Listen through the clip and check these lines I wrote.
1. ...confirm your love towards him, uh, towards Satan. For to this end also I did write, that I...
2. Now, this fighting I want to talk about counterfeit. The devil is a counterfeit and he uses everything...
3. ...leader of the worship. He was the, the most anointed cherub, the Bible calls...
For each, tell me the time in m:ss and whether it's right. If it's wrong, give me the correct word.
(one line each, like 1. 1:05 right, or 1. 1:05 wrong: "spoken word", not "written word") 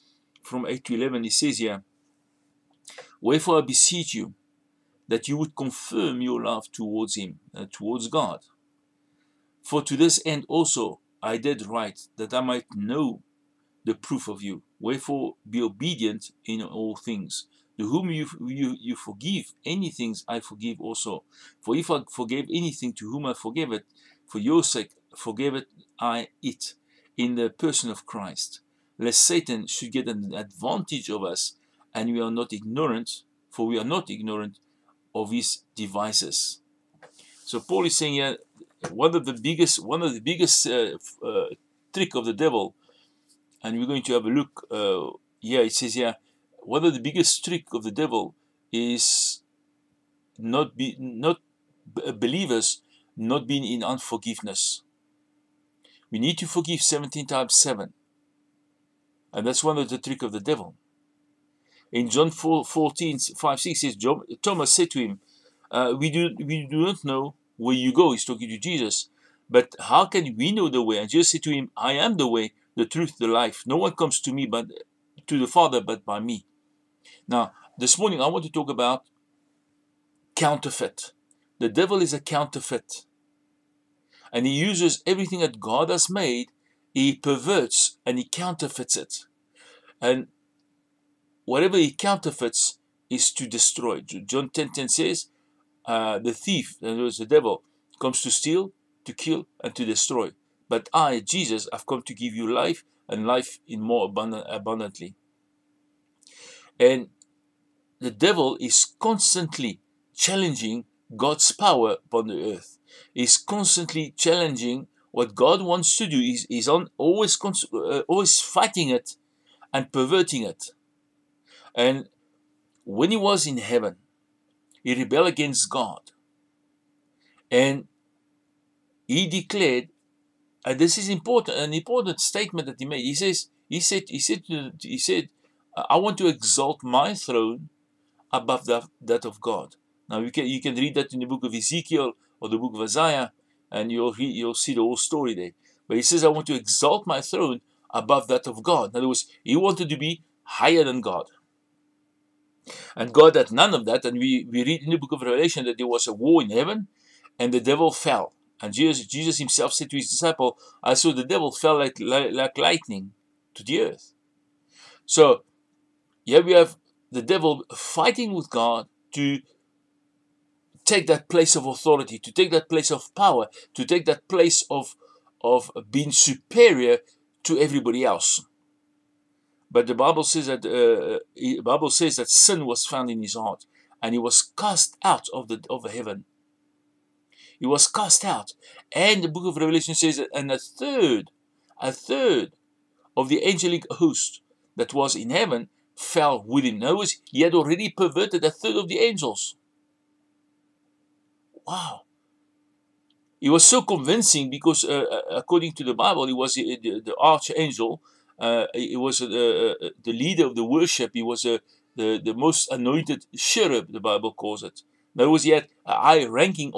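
1. 0:05 wrong: "God", not "Satan"
2. 1:17 wrong: "morning", not "fighting"
3. 3:30 right.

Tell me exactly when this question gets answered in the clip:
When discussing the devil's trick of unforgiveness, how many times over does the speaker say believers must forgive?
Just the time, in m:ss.
0:56.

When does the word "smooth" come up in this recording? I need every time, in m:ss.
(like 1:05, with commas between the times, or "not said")
not said.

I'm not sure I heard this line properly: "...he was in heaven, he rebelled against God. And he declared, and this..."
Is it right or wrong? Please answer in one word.
right.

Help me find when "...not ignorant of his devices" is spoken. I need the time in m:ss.
0:33.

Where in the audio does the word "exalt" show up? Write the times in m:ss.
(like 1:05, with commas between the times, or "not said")
2:16, 2:26.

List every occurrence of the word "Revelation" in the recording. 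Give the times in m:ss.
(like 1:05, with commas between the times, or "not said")
2:35, 3:09.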